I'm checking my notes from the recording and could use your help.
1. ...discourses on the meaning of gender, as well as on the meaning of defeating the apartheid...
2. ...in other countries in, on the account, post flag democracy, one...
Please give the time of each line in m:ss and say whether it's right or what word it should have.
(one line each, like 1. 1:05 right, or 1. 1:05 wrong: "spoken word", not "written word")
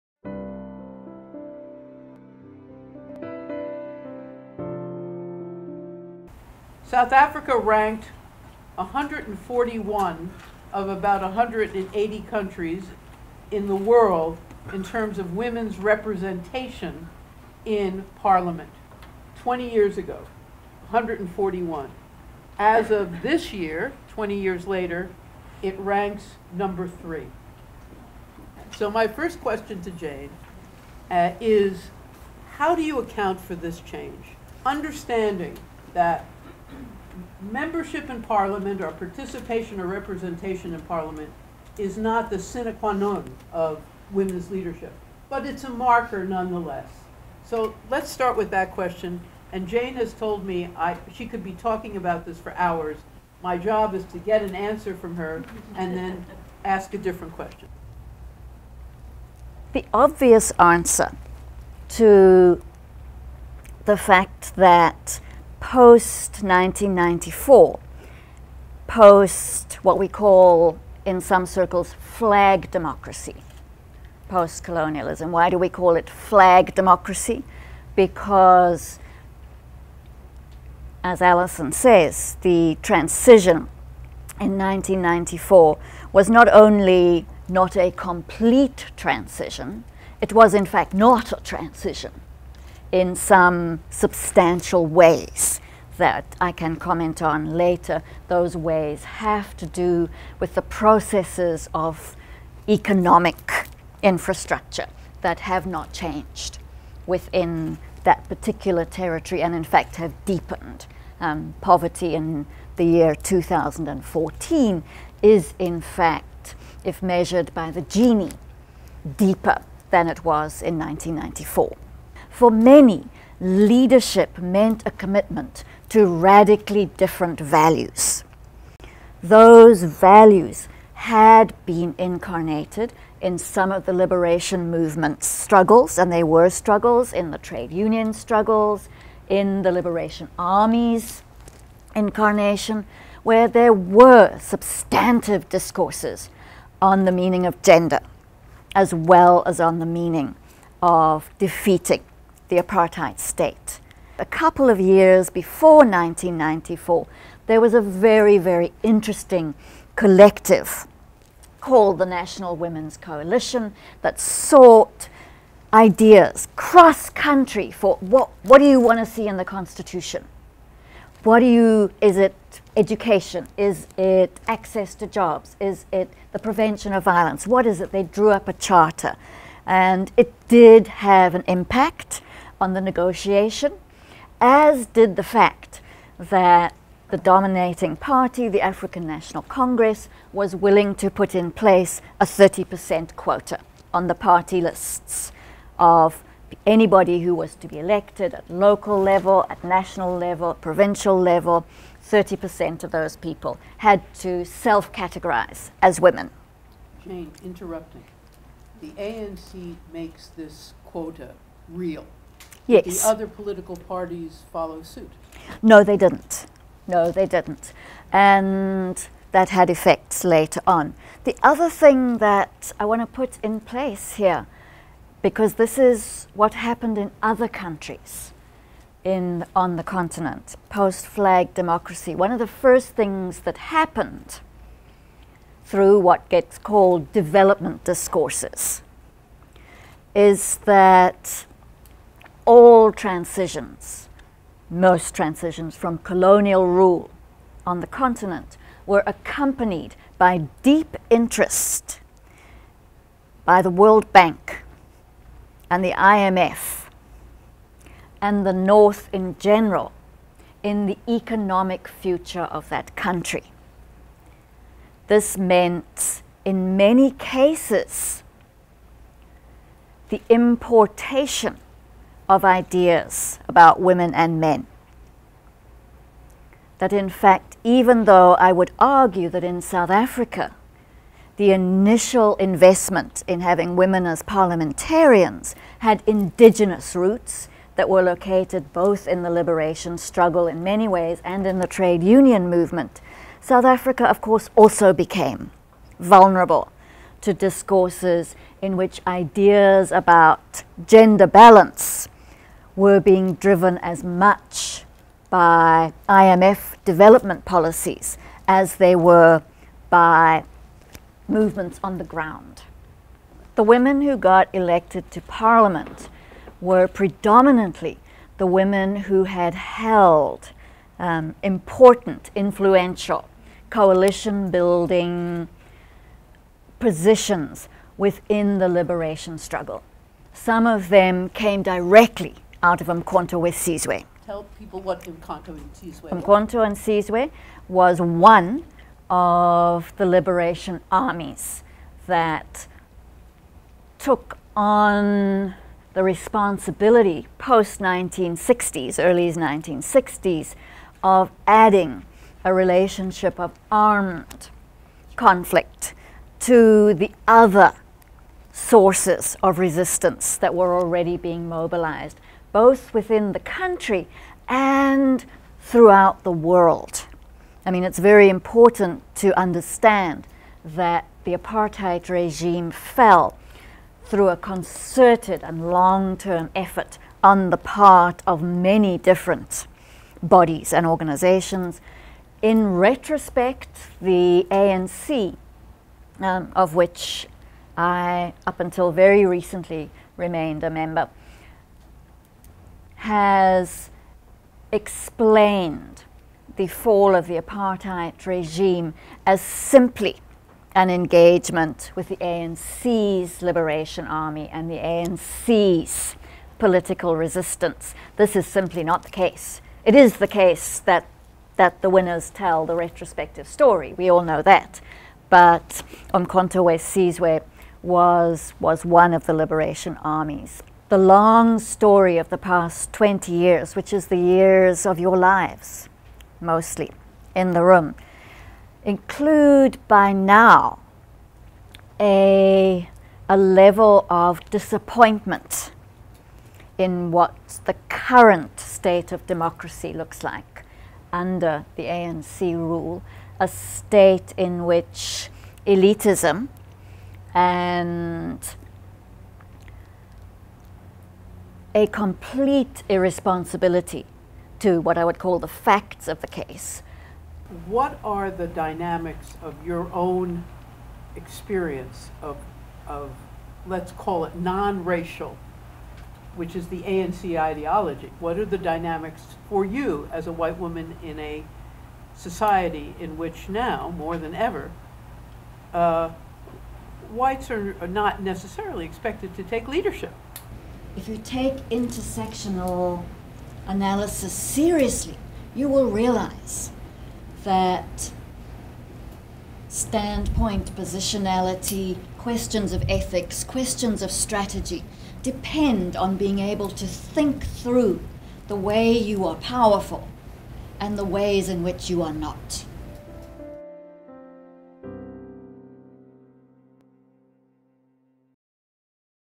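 1. 2:25 right
2. 3:46 wrong: "continent", not "account".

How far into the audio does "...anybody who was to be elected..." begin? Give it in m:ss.
3:16.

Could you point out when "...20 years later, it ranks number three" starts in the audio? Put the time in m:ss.
0:24.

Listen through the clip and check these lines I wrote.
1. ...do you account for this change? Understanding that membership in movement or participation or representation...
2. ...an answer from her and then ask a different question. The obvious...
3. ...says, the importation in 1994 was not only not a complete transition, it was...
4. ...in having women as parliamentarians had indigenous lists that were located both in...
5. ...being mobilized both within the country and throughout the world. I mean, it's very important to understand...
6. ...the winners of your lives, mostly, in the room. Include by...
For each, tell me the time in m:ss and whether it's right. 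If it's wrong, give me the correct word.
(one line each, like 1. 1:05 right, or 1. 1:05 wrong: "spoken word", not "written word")
1. 0:32 wrong: "parliament", not "movement"
2. 0:54 right
3. 1:21 wrong: "transition", not "importation"
4. 4:43 wrong: "roots", not "lists"
5. 6:01 right
6. 7:04 wrong: "years", not "winners".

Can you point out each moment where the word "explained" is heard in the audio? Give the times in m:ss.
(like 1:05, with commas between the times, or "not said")
6:34.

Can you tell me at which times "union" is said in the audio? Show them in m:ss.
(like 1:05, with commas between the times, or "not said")
2:17, 4:52.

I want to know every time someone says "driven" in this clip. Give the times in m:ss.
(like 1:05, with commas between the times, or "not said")
5:03.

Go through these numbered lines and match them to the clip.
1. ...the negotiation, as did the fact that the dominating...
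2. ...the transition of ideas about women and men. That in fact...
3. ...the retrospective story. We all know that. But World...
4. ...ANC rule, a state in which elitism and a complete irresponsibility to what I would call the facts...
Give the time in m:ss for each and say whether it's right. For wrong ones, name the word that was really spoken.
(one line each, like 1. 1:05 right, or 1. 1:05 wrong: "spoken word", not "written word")
1. 3:02 right
2. 4:30 wrong: "importation", not "transition"
3. 6:52 wrong: "Umkhonto", not "World"
4. 7:21 right.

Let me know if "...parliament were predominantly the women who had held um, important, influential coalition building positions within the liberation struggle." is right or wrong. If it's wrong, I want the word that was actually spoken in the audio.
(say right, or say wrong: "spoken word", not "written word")
right.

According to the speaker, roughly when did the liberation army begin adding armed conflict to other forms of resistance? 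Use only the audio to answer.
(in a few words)
early 1960s.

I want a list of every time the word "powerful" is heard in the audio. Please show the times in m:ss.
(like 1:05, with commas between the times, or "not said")
8:19.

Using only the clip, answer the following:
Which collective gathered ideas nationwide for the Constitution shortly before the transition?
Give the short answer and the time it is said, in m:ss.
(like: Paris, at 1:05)
National Women's Coalition, at 2:42.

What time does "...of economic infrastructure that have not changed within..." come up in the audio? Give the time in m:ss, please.
1:41.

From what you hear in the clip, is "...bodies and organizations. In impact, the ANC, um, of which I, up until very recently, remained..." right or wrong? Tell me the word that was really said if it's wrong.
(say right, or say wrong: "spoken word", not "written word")
wrong: "retrospect", not "impact".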